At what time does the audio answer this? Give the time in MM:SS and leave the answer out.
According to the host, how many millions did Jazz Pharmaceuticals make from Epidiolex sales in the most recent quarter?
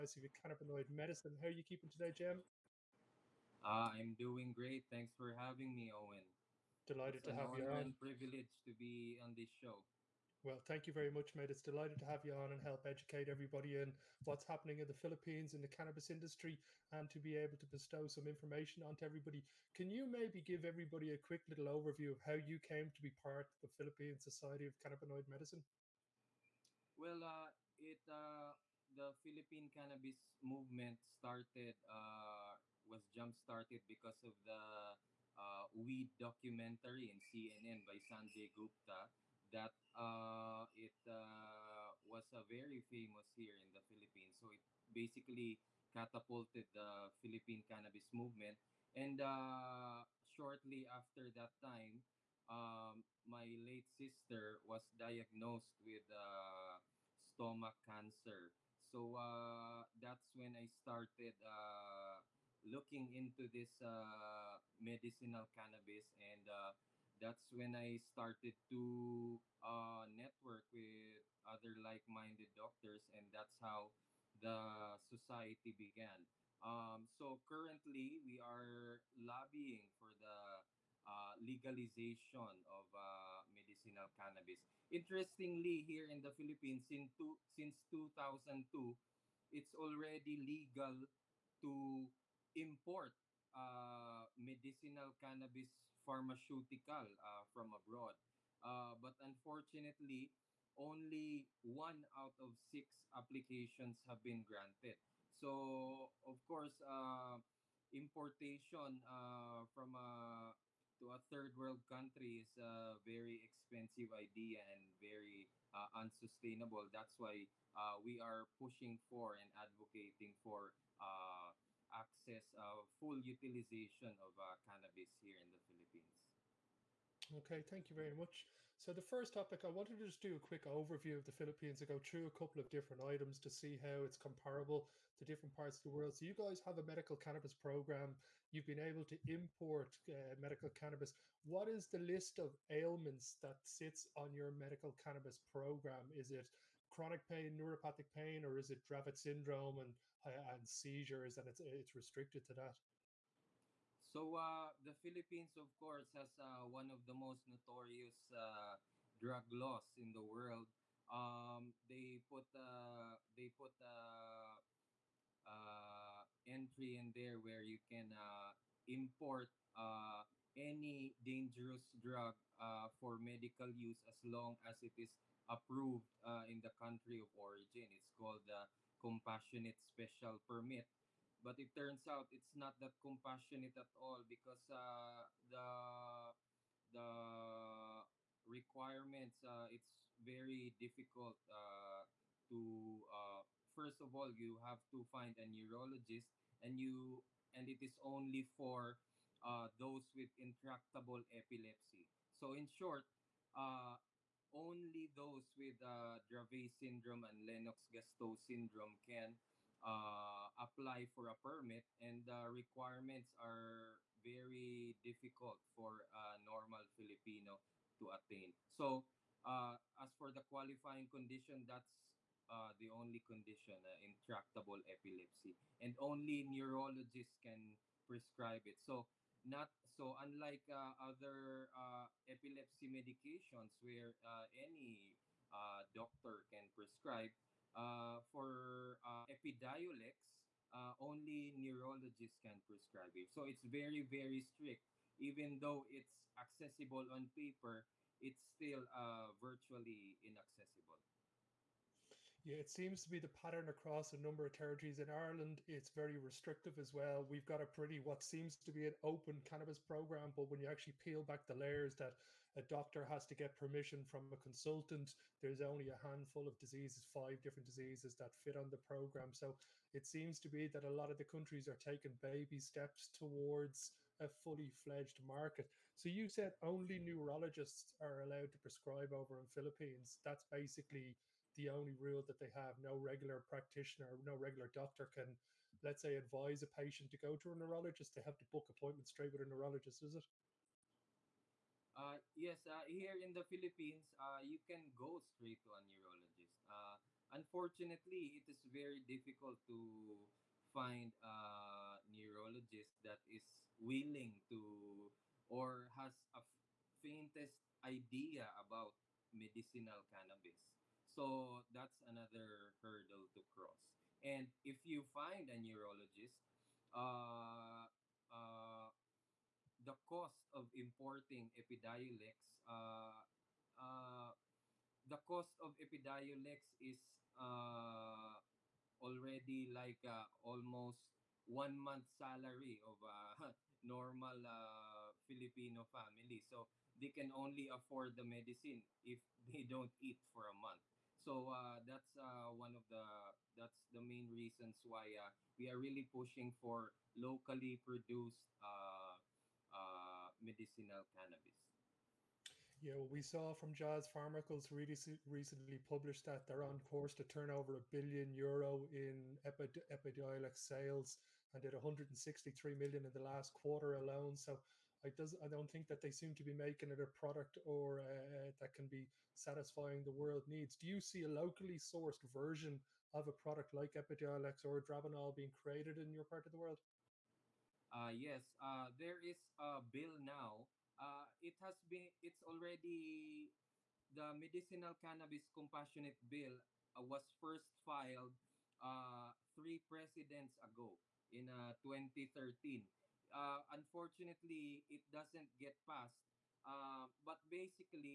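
06:01.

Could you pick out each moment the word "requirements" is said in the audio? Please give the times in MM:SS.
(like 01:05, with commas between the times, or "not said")
03:08, 03:32.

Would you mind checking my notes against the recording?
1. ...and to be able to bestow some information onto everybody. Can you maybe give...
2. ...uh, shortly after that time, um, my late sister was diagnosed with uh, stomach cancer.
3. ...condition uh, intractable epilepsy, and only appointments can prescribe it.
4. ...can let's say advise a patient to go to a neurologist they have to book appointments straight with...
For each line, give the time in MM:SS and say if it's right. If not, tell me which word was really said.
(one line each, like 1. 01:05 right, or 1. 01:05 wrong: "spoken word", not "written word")
1. 00:16 right
2. 00:49 right
3. 03:43 wrong: "neurologists", not "appointments"
4. 04:45 right.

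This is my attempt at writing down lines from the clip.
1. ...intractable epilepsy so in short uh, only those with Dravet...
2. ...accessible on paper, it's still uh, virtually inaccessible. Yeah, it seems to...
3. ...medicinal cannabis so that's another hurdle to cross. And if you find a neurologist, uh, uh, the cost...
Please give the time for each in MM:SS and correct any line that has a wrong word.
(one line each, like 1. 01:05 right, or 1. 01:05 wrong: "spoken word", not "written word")
1. 03:20 right
2. 04:06 right
3. 05:09 right.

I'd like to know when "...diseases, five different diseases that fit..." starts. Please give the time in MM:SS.
04:26.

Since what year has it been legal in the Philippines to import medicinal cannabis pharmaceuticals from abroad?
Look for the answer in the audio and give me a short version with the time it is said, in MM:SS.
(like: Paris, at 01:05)
2002, at 01:27.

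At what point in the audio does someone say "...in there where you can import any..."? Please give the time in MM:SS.
02:46.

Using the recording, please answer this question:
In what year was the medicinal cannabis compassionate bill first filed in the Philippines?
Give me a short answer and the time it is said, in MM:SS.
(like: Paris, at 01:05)
2013, at 06:31.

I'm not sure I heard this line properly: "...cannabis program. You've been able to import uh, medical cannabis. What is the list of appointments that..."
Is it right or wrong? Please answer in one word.
wrong.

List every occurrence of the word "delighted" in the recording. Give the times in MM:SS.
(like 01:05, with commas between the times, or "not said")
00:06, 00:11.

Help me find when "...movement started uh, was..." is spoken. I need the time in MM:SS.
00:30.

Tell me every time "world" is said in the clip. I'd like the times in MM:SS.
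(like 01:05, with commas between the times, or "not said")
01:51, 02:15, 02:40, 06:10, 06:16.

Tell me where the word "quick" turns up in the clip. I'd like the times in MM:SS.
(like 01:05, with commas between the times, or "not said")
00:21, 02:10.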